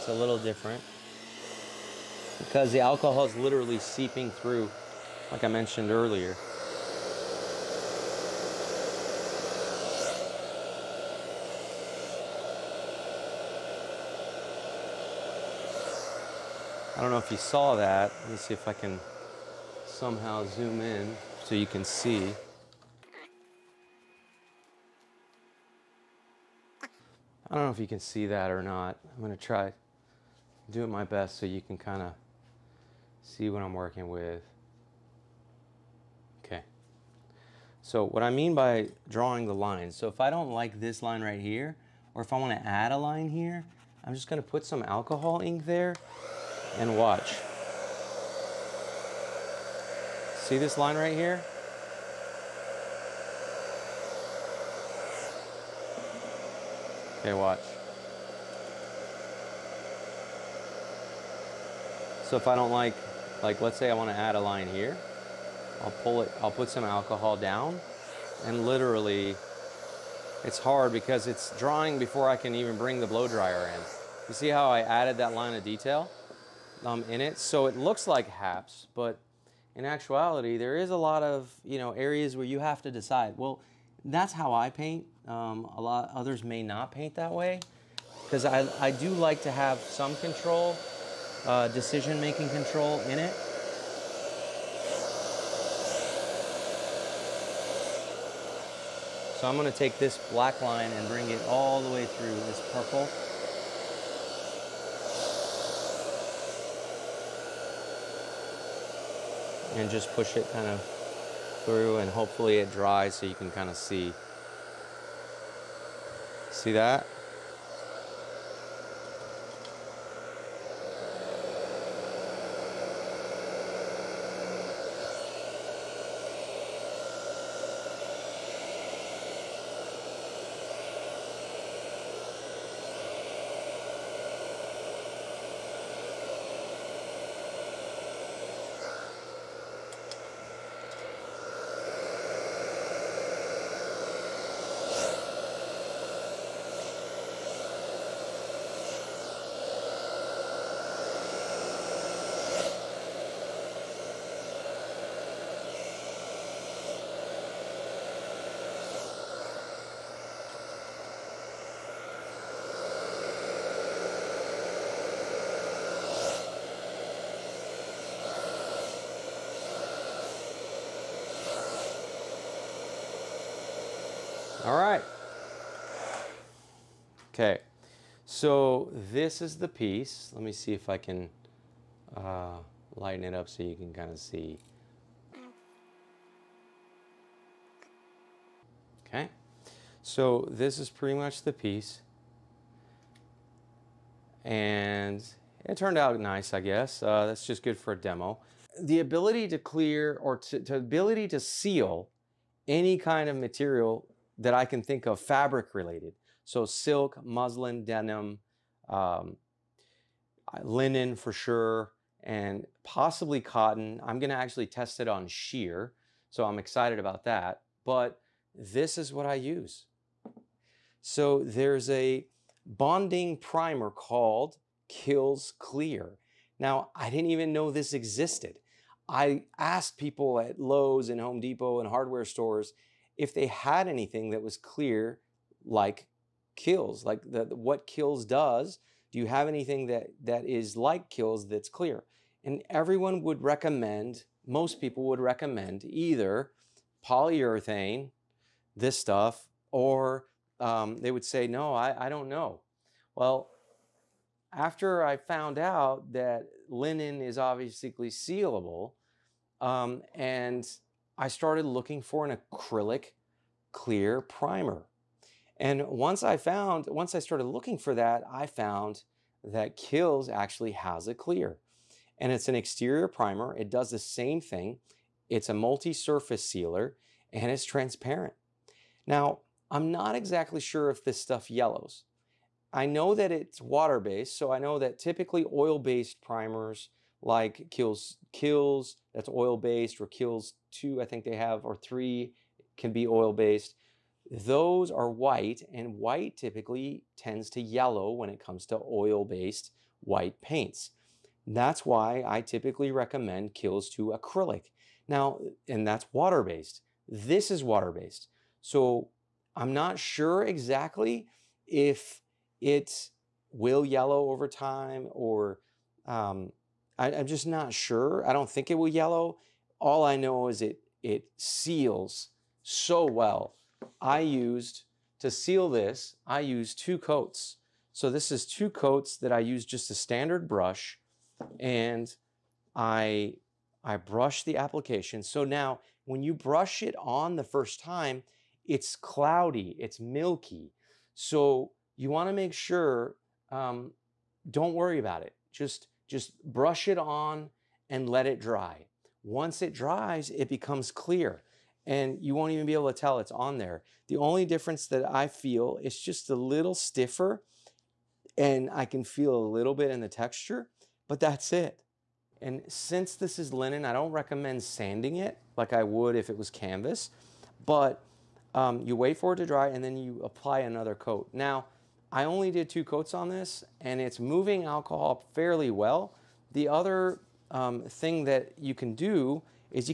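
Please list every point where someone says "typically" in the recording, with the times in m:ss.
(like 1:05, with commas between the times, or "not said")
4:44, 4:56, 5:02.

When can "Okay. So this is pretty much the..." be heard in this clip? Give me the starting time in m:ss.
3:09.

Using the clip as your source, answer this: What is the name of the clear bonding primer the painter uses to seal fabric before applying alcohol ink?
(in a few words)
Kilz Clear.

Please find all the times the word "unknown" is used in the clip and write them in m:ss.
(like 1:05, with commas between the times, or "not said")
not said.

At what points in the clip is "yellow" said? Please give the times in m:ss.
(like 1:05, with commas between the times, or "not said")
4:41, 4:57, 5:13, 5:18.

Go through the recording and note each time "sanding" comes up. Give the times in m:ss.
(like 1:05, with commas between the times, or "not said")
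6:04.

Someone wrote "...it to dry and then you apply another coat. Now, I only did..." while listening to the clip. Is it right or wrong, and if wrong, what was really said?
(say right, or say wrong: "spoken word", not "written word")
right.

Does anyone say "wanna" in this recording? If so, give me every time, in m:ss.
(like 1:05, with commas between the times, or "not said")
0:42, 5:42.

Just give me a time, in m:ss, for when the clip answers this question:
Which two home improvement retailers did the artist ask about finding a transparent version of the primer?
3:50.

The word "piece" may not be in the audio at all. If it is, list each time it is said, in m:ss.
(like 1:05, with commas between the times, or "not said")
2:59, 3:11.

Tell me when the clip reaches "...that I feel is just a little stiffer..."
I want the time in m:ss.
5:54.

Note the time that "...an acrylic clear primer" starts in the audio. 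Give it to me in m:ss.
4:22.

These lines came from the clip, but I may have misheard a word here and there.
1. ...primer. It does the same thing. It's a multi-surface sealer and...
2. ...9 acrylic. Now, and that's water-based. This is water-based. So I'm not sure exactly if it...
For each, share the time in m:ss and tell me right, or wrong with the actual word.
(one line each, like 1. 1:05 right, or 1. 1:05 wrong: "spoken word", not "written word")
1. 4:33 right
2. 5:03 wrong: "2", not "9".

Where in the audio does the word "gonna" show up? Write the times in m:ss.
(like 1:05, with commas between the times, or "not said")
0:29, 0:44, 1:39, 3:34.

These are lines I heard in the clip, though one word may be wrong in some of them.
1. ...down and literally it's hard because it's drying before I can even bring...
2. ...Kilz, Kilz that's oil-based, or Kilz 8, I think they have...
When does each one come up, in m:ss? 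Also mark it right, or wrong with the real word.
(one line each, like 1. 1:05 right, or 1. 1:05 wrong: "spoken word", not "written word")
1. 1:07 right
2. 4:47 wrong: "2", not "8".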